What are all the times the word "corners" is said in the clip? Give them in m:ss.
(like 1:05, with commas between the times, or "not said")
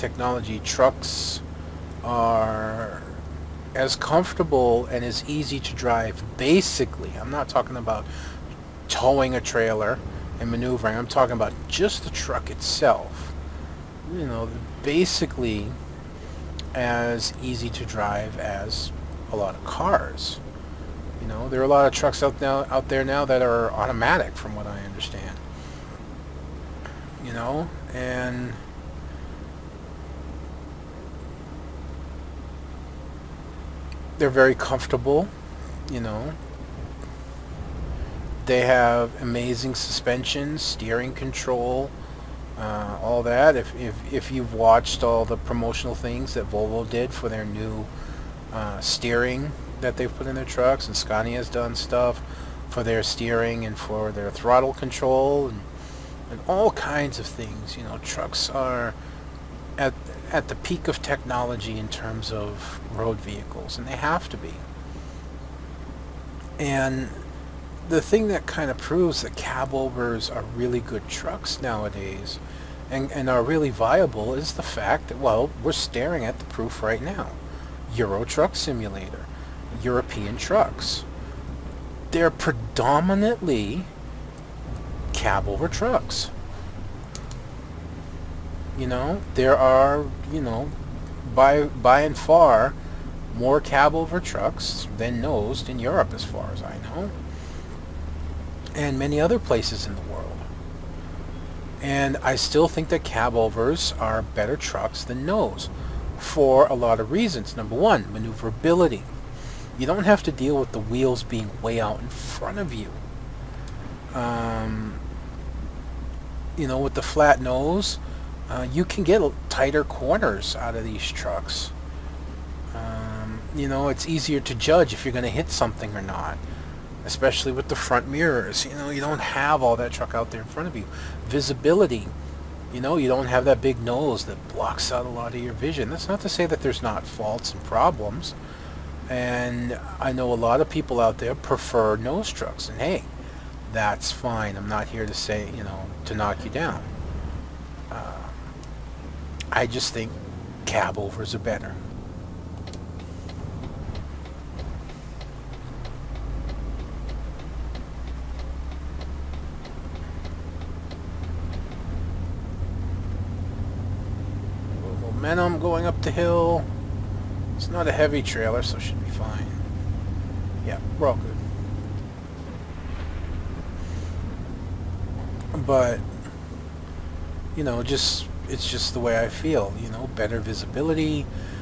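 1:59.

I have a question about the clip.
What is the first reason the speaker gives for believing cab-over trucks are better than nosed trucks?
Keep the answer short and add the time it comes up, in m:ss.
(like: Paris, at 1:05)
Maneuverability, at 1:48.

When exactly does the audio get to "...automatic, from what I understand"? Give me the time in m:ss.
0:23.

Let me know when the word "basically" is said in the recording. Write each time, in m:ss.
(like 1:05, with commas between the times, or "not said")
0:06, 0:14.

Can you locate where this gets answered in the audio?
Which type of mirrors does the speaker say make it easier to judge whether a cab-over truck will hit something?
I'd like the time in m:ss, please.
2:07.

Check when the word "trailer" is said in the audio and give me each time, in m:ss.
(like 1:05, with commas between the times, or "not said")
0:09, 2:48.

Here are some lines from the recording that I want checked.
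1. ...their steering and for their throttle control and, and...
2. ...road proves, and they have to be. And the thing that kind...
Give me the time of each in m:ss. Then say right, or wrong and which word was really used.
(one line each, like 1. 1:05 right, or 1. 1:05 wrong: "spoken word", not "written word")
1. 0:52 right
2. 1:02 wrong: "vehicles", not "proves".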